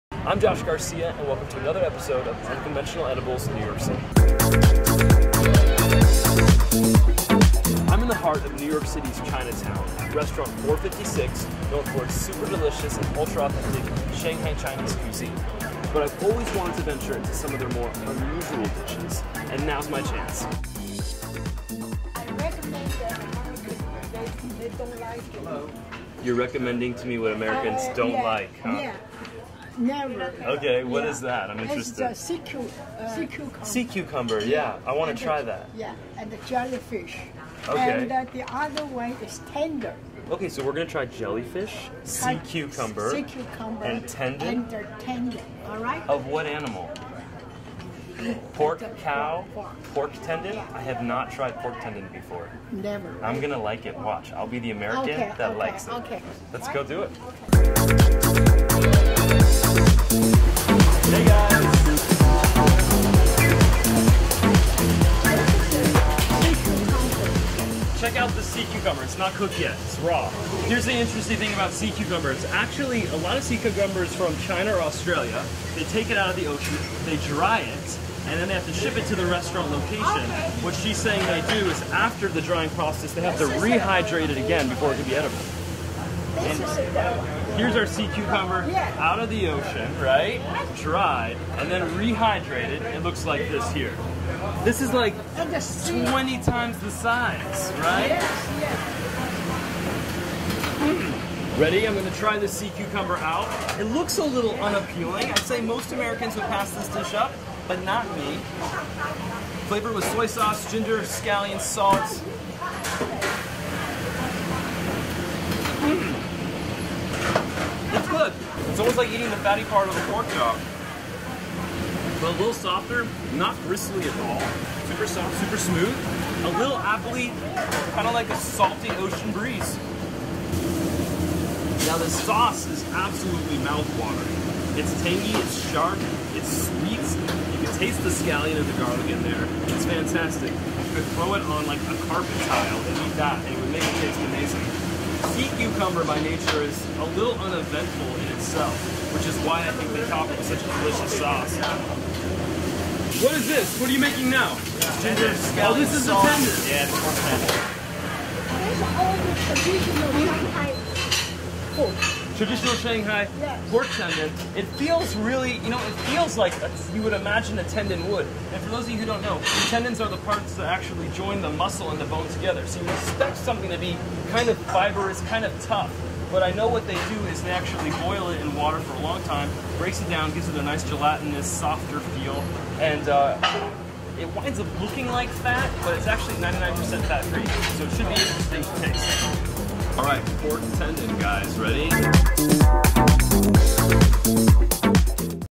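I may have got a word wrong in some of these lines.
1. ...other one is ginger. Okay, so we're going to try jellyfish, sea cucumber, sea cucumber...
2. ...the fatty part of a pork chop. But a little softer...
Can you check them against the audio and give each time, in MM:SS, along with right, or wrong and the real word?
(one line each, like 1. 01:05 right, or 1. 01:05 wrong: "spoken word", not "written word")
1. 00:38 wrong: "tender", not "ginger"
2. 01:59 right.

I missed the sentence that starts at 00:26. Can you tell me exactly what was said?
You're recommending to me what Americans uh, don't yeah, like, huh?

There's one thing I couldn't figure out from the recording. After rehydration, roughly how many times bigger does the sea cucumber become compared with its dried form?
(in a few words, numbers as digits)
20 times.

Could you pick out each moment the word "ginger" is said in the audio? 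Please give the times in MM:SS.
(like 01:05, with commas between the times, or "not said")
01:50, 02:35.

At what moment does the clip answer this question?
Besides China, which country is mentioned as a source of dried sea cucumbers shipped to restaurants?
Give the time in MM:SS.
01:14.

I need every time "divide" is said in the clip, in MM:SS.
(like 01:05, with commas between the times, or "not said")
not said.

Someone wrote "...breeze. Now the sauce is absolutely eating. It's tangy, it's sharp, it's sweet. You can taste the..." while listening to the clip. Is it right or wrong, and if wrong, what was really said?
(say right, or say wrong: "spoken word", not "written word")
wrong: "mouthwatering", not "eating".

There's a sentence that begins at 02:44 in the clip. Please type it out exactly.
It feels really, you know, it feels like a, you would imagine a tendon would.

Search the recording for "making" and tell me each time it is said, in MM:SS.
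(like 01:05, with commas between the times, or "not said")
02:33.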